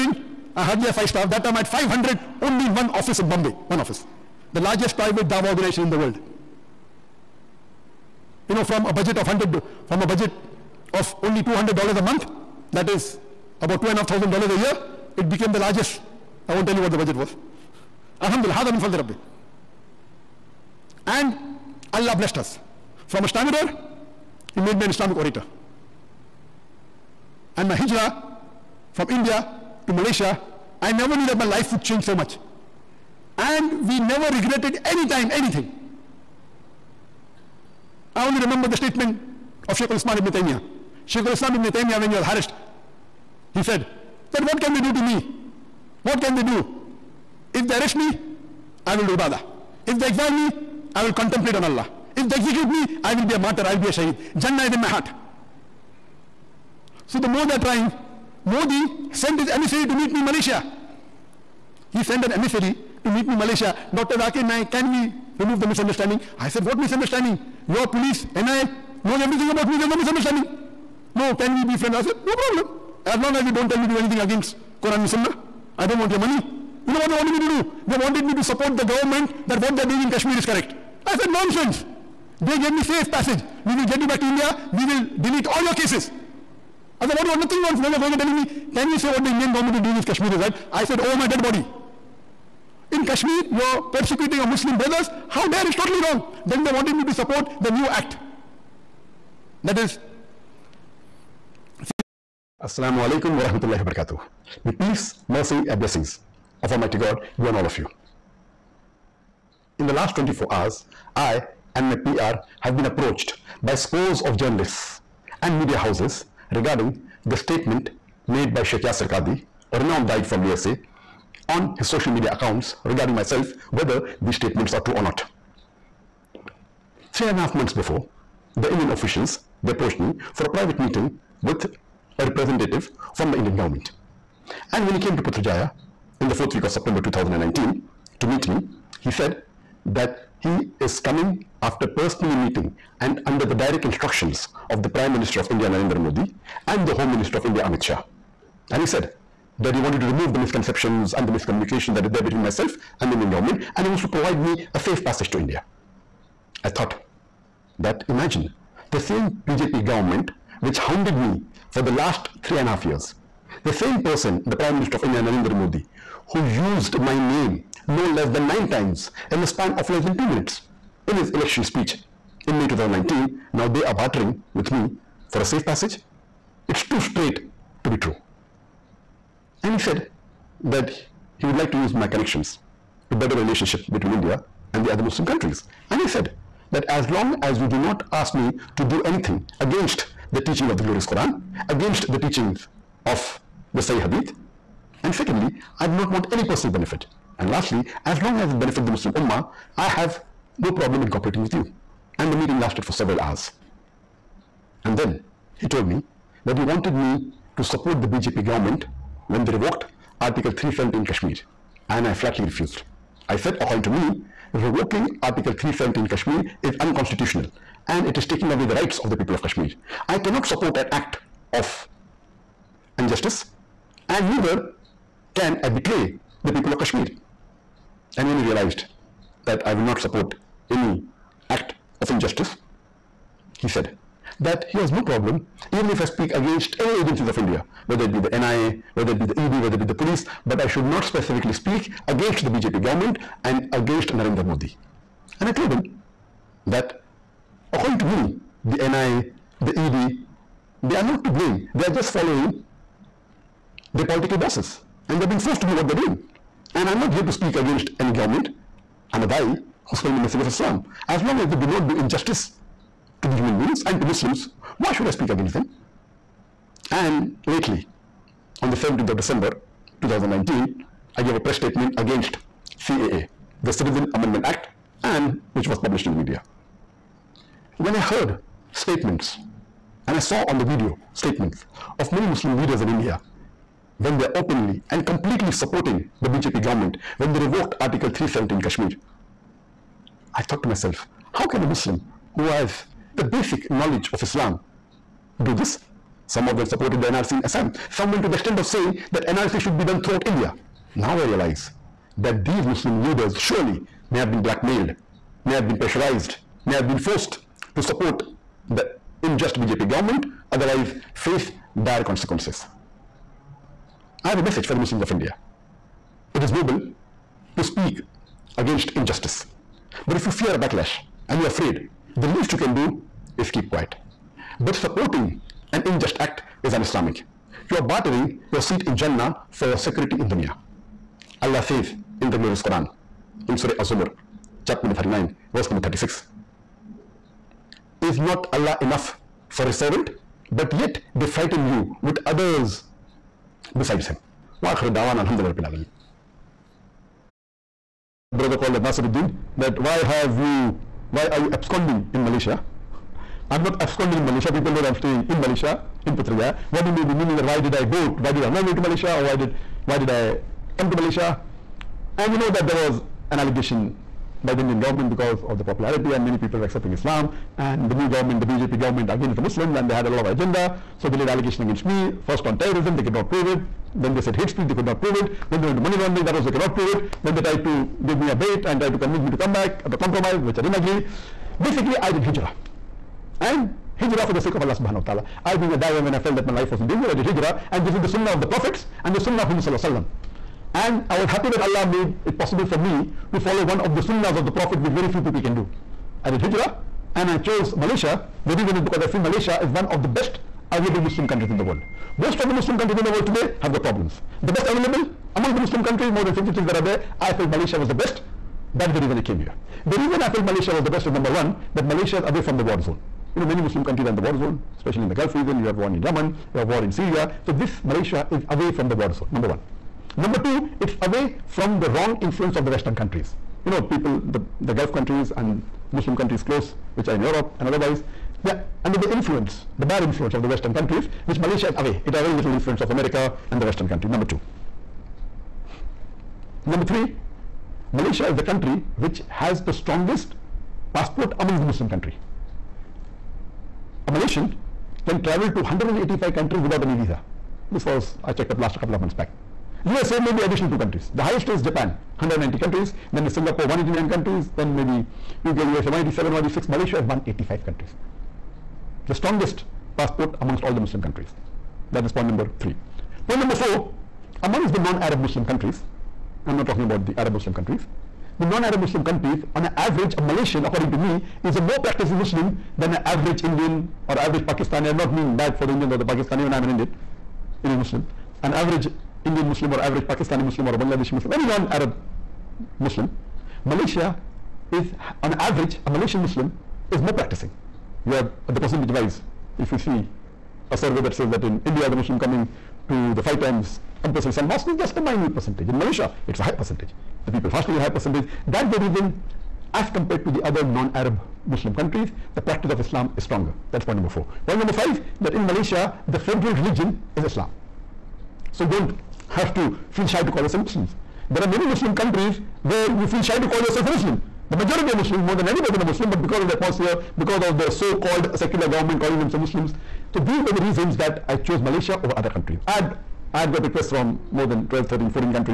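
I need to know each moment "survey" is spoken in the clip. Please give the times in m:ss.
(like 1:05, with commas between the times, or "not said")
8:10.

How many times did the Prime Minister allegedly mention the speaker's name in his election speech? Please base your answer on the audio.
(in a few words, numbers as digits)
9.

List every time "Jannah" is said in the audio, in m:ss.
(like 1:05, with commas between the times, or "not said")
0:54, 5:28.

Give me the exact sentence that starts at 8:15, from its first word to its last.
In Malaysia, it's a high percentage.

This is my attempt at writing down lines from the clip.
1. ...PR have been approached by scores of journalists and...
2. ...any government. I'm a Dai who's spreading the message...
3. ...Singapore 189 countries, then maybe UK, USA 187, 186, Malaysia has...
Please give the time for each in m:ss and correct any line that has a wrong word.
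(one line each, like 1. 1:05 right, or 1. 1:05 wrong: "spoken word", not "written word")
1. 1:51 right
2. 4:17 right
3. 7:33 right.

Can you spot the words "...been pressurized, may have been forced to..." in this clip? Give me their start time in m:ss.
5:05.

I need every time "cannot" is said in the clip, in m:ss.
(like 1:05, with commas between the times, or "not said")
3:40, 6:16.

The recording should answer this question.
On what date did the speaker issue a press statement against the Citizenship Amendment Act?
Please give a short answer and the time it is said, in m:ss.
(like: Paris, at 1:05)
17 December 2019, at 4:28.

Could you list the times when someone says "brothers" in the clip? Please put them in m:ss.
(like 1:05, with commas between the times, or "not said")
1:34, 5:48.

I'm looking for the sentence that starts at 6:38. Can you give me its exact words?
The reason is because I feel Malaysia is one of the best available Muslim countries in the world.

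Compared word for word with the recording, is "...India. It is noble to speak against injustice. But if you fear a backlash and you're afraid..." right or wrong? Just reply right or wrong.
right.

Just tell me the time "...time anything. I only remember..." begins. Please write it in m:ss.
0:35.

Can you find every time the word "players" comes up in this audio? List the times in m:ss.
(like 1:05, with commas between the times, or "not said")
not said.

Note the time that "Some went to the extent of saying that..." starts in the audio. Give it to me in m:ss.
4:57.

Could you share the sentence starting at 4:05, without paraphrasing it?
And I told him that according to me, the NIA, the ED, they are not to blame.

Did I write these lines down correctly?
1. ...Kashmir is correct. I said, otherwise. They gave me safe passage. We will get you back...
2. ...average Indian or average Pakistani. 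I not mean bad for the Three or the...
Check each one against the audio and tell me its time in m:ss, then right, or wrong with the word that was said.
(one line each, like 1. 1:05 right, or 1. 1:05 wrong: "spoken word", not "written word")
1. 1:20 wrong: "nonsense", not "otherwise"
2. 7:53 wrong: "Indians", not "Three".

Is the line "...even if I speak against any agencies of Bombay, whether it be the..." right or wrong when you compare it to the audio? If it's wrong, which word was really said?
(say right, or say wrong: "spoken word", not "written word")
wrong: "India", not "Bombay".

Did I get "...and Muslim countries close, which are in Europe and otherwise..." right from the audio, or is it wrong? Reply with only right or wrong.
right.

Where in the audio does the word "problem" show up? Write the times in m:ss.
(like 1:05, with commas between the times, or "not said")
1:12, 3:20, 3:55, 6:43.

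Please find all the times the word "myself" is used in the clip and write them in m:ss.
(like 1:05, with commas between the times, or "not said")
2:03, 2:32, 4:50.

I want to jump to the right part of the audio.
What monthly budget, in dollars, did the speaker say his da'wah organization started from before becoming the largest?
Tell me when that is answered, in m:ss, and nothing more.
0:11.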